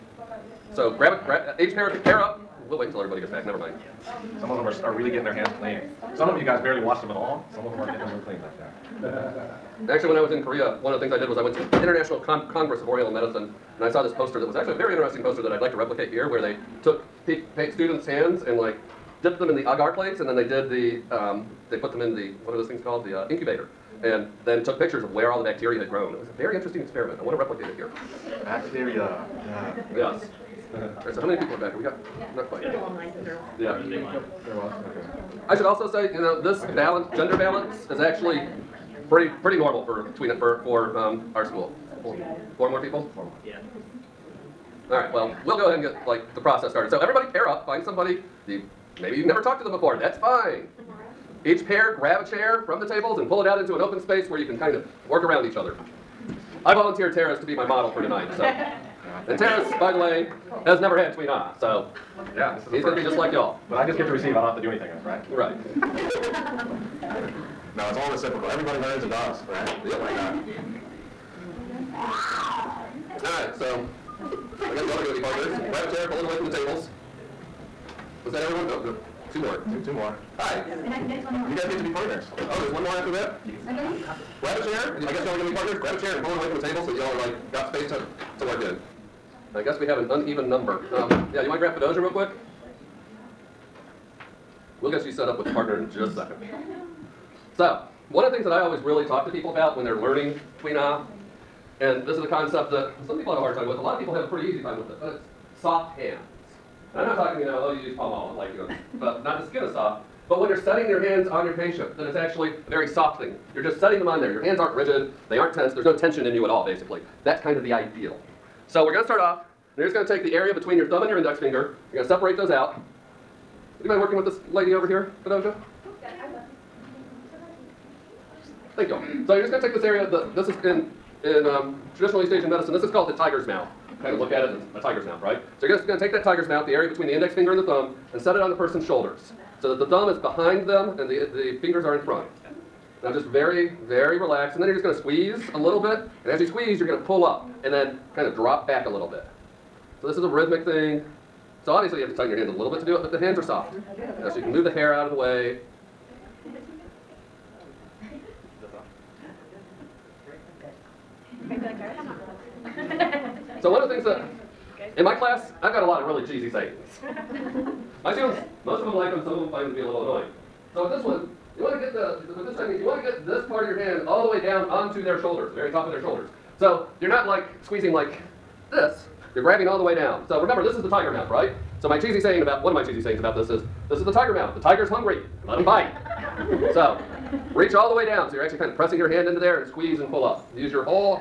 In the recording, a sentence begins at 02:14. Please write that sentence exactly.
Kind of look at it, and a tiger's mouth, right?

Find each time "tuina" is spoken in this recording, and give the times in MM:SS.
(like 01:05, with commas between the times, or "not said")
00:40, 01:01, 01:40.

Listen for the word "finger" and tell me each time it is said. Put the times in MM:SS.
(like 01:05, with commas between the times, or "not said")
02:01, 02:17, 02:21.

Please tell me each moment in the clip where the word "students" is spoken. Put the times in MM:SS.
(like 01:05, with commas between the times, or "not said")
00:17, 02:48.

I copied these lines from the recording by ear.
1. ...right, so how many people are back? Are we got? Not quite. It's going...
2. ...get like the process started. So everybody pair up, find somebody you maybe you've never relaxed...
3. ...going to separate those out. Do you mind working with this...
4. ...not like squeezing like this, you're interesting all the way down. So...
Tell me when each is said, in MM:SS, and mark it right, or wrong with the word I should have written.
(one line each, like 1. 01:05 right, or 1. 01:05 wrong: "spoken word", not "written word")
1. 00:31 right
2. 00:45 wrong: "talked", not "relaxed"
3. 02:01 right
4. 02:57 wrong: "grabbing", not "interesting".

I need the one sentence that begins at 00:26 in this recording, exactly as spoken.
It was a very interesting experiment.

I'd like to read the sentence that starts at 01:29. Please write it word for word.
I guess we have an uneven number.